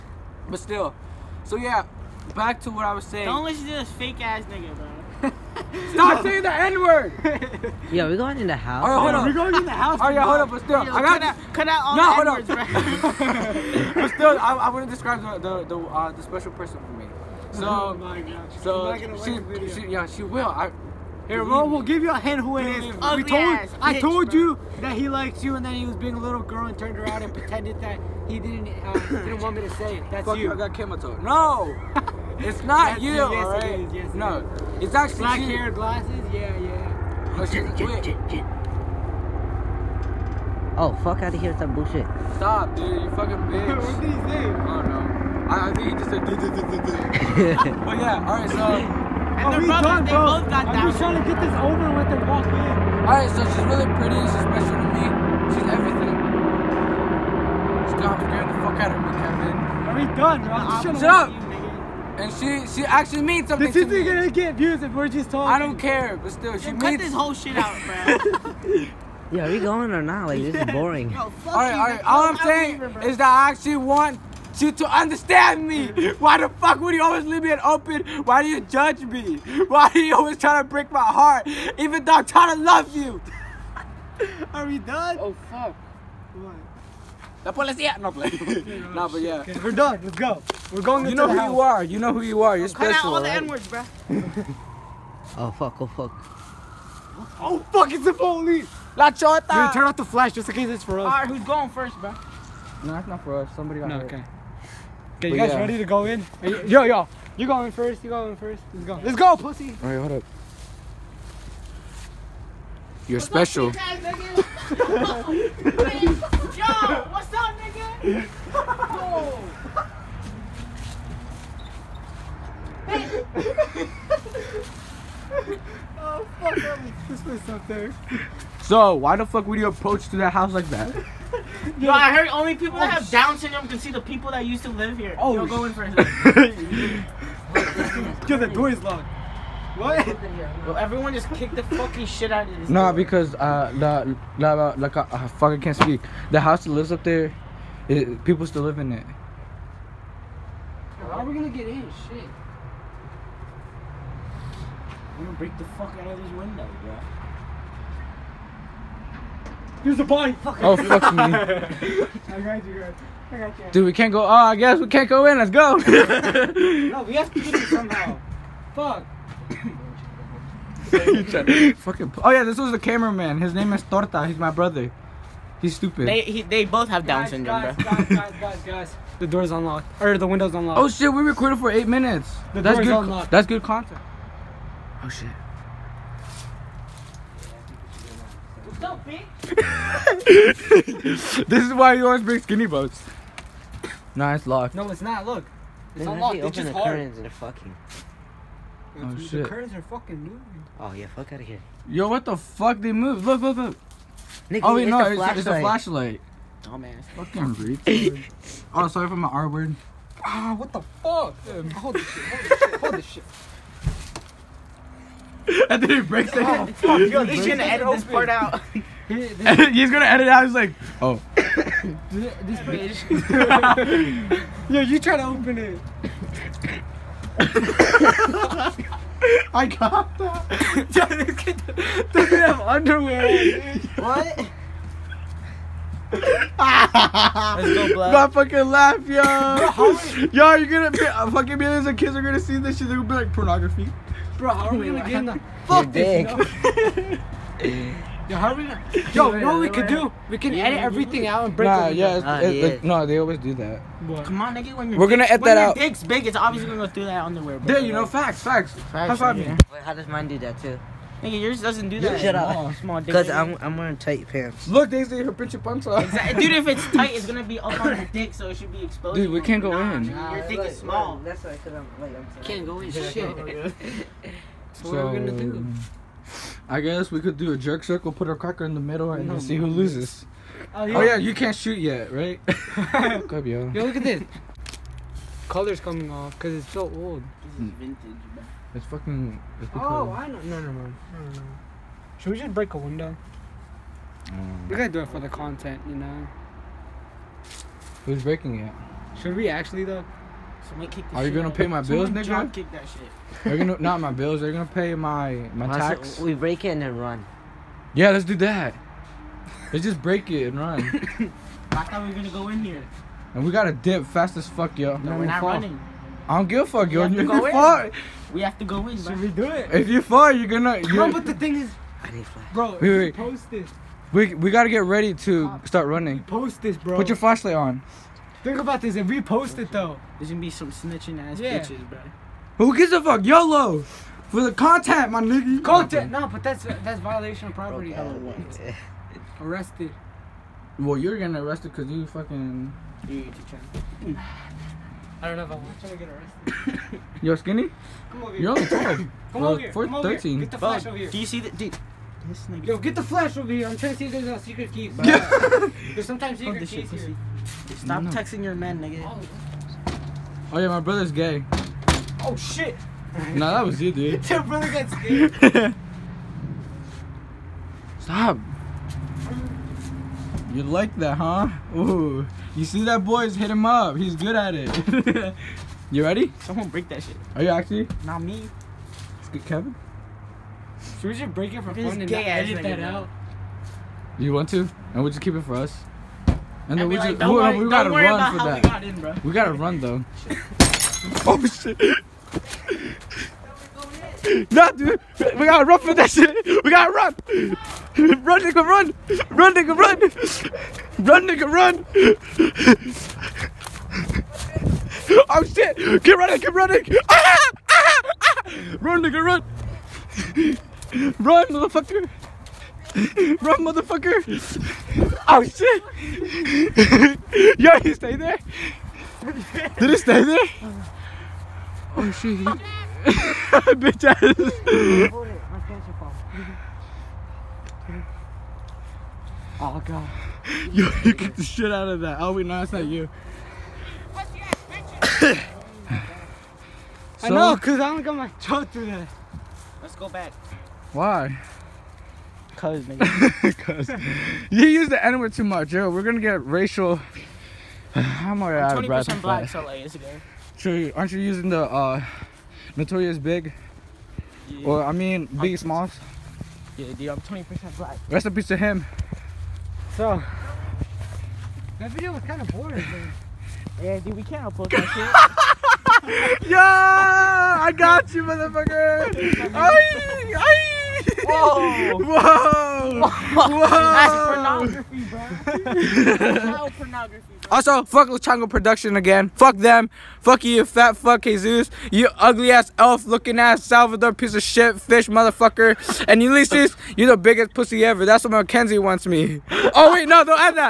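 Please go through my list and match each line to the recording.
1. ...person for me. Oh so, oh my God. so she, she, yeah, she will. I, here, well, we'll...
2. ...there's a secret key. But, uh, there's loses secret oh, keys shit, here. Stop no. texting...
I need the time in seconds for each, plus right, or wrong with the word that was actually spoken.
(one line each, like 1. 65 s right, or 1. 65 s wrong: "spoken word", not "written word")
1. 16 s right
2. 354 s wrong: "sometimes", not "loses".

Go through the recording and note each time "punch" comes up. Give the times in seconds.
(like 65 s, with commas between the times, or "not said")
265 s.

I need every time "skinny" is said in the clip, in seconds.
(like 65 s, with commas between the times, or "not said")
192 s, 347 s.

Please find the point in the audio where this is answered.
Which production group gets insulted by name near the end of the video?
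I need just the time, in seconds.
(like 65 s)
478 s.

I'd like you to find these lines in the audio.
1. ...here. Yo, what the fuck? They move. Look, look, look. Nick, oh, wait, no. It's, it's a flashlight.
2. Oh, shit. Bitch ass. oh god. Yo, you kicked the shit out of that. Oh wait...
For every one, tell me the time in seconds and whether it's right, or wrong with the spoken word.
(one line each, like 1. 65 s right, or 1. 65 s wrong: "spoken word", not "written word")
1. 201 s right
2. 421 s right.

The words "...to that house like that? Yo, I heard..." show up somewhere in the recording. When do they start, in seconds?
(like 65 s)
130 s.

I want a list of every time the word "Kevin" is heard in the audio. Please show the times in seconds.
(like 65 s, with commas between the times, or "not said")
59 s, 379 s.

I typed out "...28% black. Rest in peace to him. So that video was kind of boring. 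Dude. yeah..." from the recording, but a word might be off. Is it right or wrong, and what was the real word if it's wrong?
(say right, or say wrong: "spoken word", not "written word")
wrong: "20", not "28".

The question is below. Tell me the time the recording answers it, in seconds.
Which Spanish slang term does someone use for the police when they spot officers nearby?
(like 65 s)
98 s.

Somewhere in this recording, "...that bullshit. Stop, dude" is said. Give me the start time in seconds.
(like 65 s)
41 s.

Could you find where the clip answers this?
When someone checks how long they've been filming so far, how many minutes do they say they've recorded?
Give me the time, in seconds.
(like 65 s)
181 s.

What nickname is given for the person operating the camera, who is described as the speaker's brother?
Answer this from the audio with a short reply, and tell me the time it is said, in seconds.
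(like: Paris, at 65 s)
Torta, at 173 s.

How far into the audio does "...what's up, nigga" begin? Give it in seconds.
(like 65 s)
117 s.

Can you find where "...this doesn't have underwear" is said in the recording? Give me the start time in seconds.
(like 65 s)
232 s.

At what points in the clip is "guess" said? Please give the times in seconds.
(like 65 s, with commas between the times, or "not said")
164 s, 276 s.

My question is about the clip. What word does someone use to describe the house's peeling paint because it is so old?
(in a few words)
Vintage.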